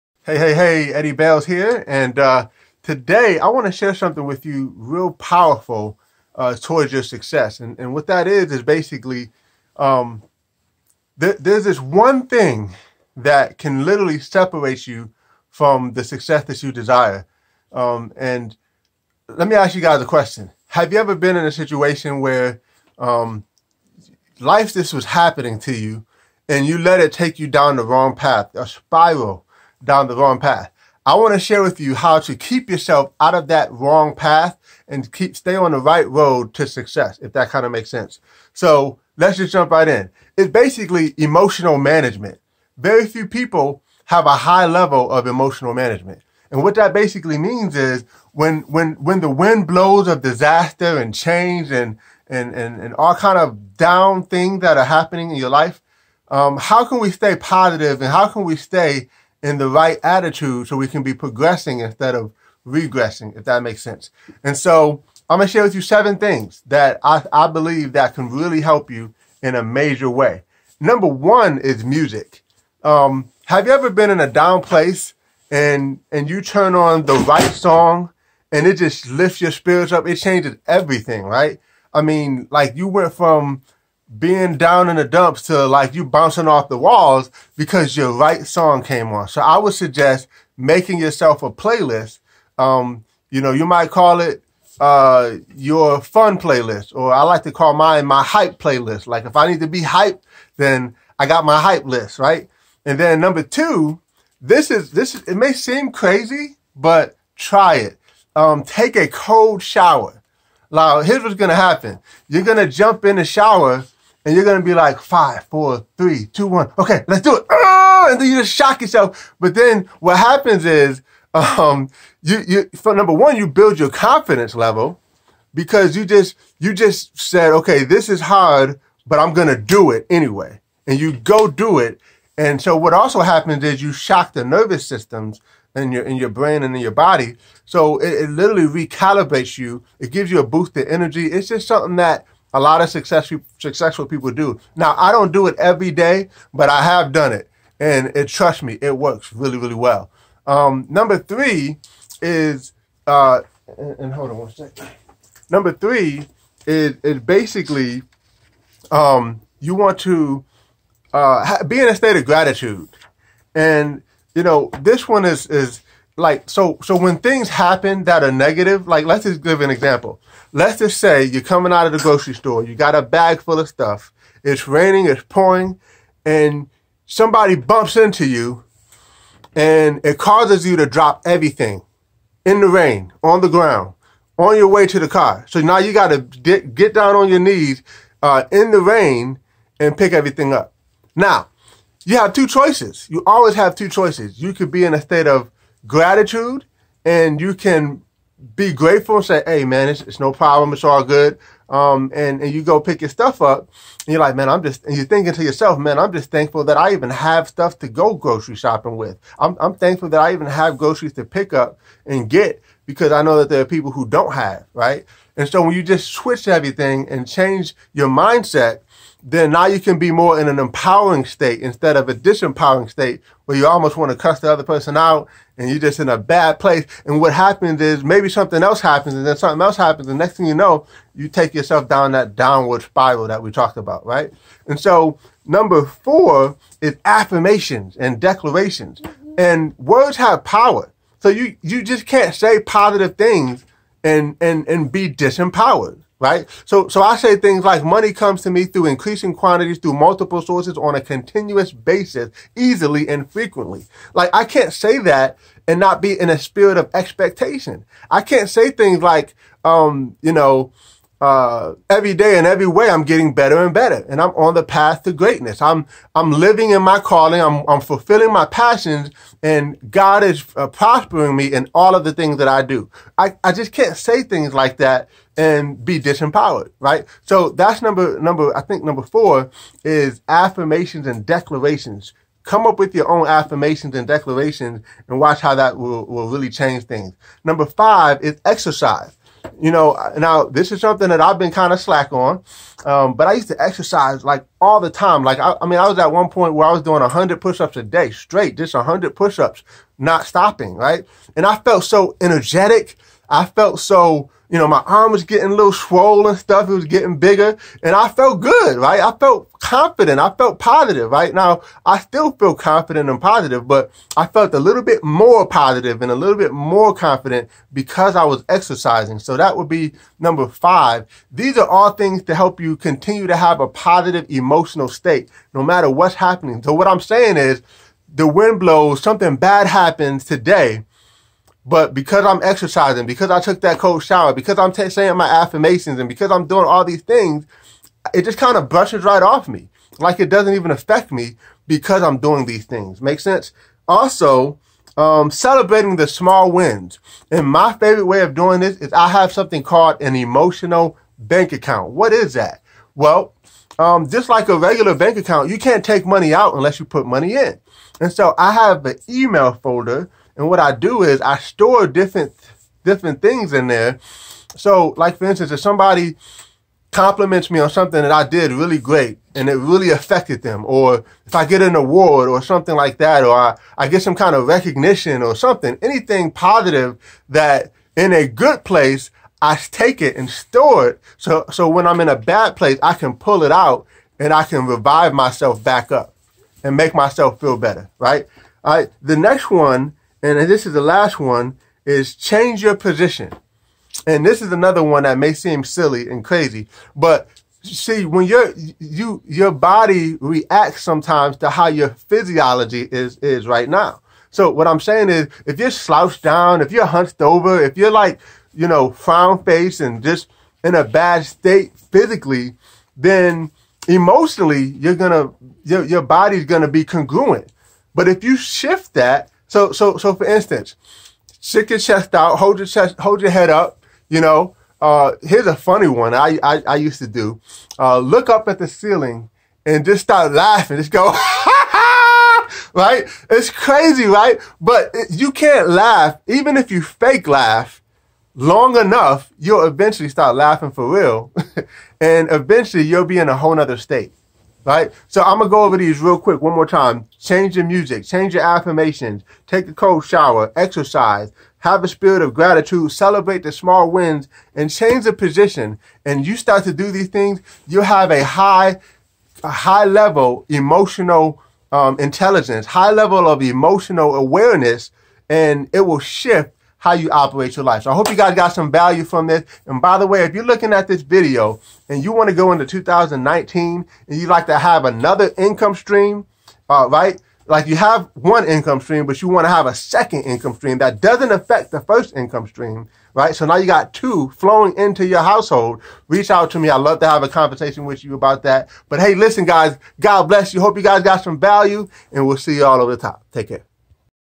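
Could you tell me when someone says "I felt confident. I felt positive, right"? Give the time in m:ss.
5:08.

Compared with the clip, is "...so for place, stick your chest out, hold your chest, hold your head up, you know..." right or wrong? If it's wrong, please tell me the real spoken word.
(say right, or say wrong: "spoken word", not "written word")
wrong: "instance", not "place".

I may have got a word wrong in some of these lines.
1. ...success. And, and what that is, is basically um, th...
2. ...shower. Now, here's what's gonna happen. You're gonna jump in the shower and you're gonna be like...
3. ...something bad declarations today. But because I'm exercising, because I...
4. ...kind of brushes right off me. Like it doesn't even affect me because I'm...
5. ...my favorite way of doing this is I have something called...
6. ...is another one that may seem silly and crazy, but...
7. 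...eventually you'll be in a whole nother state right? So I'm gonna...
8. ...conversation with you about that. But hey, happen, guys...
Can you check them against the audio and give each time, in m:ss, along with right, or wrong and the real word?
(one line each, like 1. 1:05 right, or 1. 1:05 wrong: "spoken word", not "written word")
1. 0:07 right
2. 1:49 right
3. 5:29 wrong: "happens", not "declarations"
4. 5:38 right
5. 5:47 right
6. 6:34 right
7. 7:22 right
8. 8:07 wrong: "listen", not "happen".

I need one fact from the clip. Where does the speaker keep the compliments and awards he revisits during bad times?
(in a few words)
An email folder.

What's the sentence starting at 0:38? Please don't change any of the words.
So let's just jump right in.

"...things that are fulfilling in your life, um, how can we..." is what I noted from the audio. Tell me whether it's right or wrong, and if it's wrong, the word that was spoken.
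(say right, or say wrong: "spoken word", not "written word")
wrong: "happening", not "fulfilling".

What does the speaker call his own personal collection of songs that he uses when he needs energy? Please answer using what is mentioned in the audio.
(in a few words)
Hype playlist.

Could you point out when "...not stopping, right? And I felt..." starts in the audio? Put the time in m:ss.
4:59.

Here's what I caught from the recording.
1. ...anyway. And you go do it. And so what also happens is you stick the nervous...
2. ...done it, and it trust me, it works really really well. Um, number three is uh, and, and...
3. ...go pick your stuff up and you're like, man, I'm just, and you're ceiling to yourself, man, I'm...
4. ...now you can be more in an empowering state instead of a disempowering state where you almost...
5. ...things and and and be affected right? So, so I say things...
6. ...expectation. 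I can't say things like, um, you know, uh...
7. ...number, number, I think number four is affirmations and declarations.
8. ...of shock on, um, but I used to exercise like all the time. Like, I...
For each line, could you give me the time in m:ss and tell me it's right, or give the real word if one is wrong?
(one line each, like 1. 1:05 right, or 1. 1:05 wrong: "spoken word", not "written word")
1. 2:10 wrong: "shock", not "stick"
2. 2:27 right
3. 3:22 wrong: "thinking", not "ceiling"
4. 3:39 right
5. 4:03 wrong: "disempowered", not "affected"
6. 4:16 right
7. 4:37 right
8. 4:51 wrong: "slack", not "shock".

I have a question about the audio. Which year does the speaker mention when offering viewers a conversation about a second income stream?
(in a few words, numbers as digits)
2019.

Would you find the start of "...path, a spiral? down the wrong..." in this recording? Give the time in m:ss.
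0:28.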